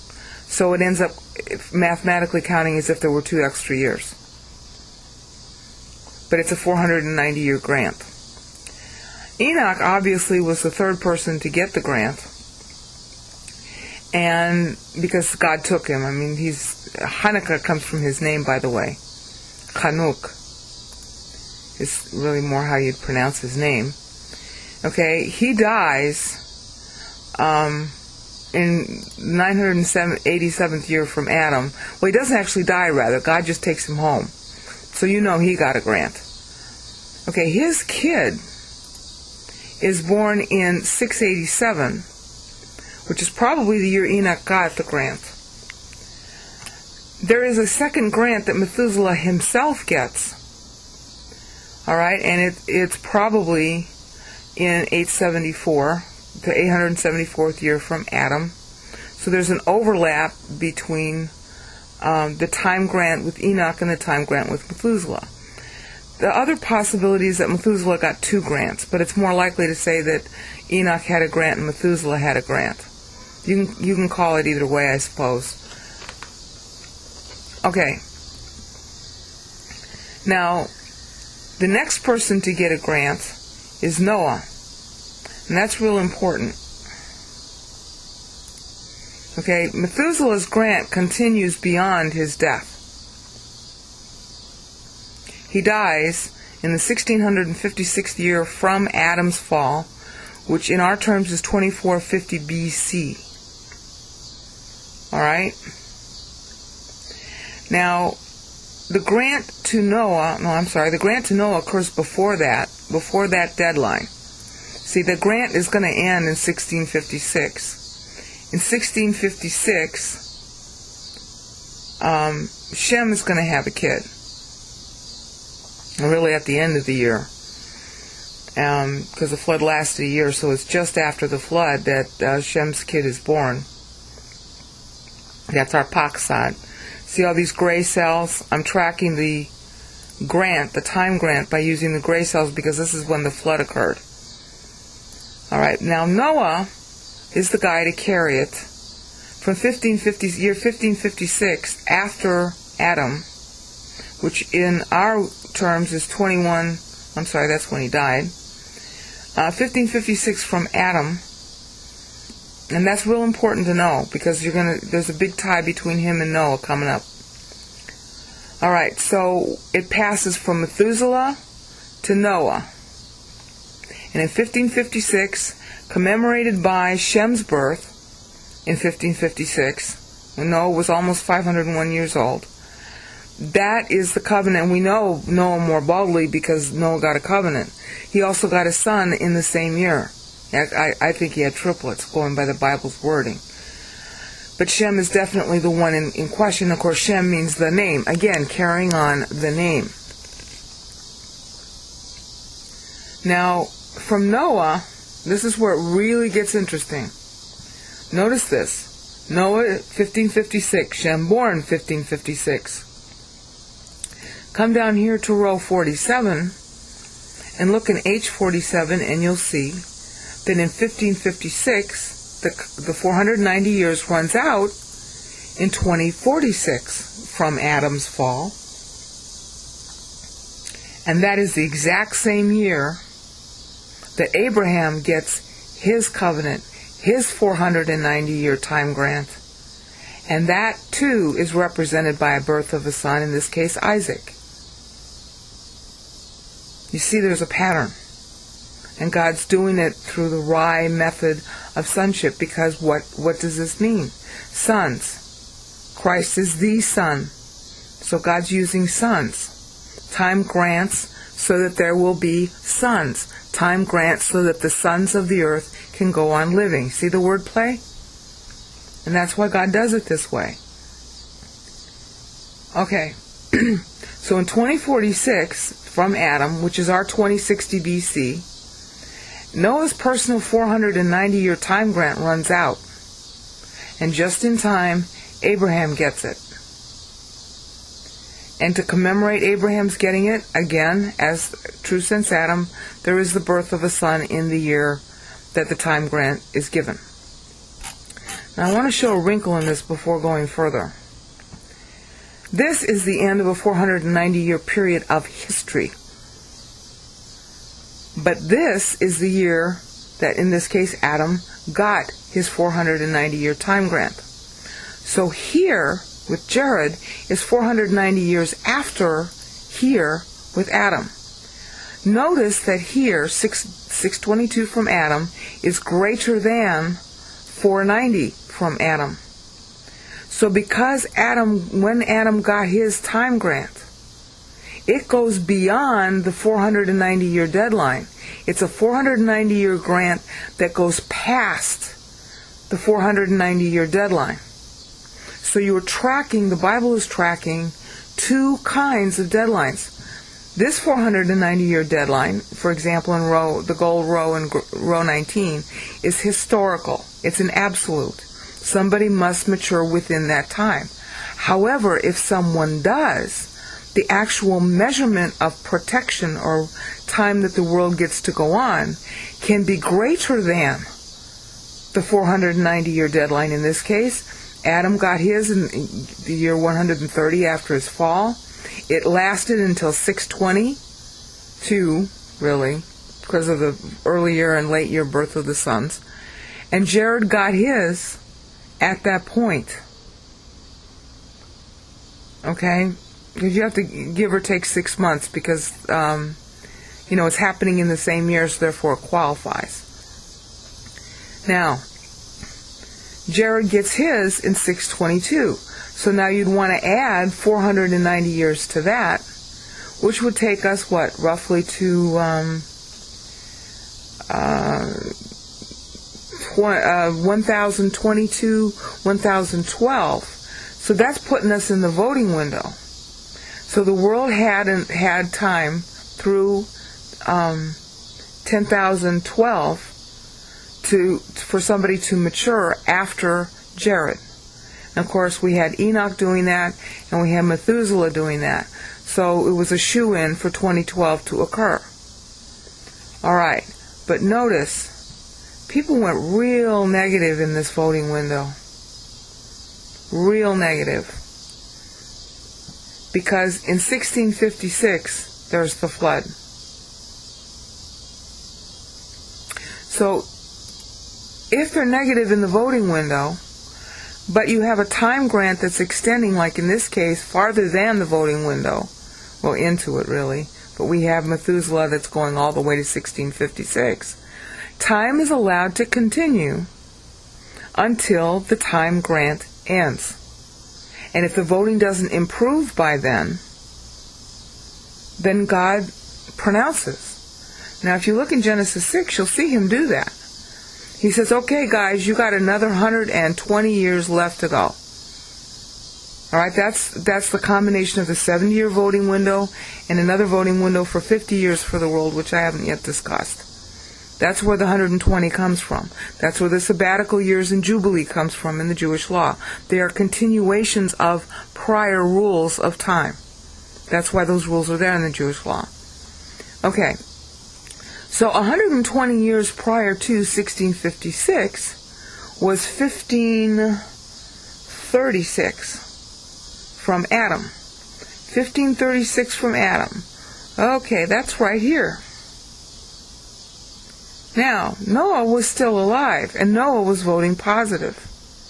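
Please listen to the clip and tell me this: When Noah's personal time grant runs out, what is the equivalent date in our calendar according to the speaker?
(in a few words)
2060 BC.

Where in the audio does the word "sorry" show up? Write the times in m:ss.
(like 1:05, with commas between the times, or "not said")
1:50, 2:37.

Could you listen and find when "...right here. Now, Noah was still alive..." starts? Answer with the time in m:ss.
8:51.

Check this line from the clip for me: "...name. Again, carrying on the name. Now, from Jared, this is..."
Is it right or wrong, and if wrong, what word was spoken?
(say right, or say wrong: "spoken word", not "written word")
wrong: "Noah", not "Jared".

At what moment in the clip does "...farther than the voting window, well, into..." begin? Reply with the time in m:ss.
7:47.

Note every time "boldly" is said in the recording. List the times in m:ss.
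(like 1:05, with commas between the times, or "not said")
3:05.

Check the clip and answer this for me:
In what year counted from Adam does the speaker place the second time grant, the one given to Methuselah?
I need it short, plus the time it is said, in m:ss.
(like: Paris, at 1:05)
874, at 0:56.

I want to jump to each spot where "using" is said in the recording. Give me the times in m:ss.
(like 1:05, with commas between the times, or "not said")
2:21, 4:18.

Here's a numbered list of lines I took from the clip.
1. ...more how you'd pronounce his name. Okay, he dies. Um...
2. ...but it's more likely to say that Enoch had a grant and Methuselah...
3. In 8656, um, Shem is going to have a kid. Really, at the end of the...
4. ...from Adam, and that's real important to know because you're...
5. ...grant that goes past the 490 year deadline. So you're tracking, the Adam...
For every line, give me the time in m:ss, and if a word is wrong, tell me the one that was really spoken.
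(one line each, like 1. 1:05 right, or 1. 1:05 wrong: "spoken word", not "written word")
1. 0:22 right
2. 1:08 right
3. 1:58 wrong: "1656", not "8656"
4. 2:40 right
5. 5:39 wrong: "Bible", not "Adam".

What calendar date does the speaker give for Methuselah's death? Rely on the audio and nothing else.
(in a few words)
2450 BC.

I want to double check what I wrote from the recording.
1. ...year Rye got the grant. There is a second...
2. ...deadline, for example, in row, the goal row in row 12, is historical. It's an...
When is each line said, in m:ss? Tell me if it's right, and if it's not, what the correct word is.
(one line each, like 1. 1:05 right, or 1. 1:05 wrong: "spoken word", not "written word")
1. 0:43 wrong: "Enoch", not "Rye"
2. 5:51 wrong: "19", not "12".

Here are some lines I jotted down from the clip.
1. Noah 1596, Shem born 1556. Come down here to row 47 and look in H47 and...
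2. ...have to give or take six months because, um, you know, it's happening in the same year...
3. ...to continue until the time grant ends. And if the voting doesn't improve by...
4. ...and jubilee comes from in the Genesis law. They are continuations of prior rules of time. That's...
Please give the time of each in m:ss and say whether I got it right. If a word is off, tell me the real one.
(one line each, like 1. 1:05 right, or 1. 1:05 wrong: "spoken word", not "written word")
1. 3:29 wrong: "1556", not "1596"
2. 6:33 right
3. 7:55 right
4. 8:27 wrong: "Jewish", not "Genesis".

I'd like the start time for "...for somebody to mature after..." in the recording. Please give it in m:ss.
7:11.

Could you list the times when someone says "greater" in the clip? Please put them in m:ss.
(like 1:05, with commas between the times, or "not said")
5:25, 6:09.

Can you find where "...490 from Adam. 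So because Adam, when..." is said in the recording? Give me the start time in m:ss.
5:26.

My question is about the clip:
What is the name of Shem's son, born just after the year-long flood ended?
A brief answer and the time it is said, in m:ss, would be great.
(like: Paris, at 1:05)
Arphaxad, at 2:15.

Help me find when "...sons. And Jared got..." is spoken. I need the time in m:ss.
6:25.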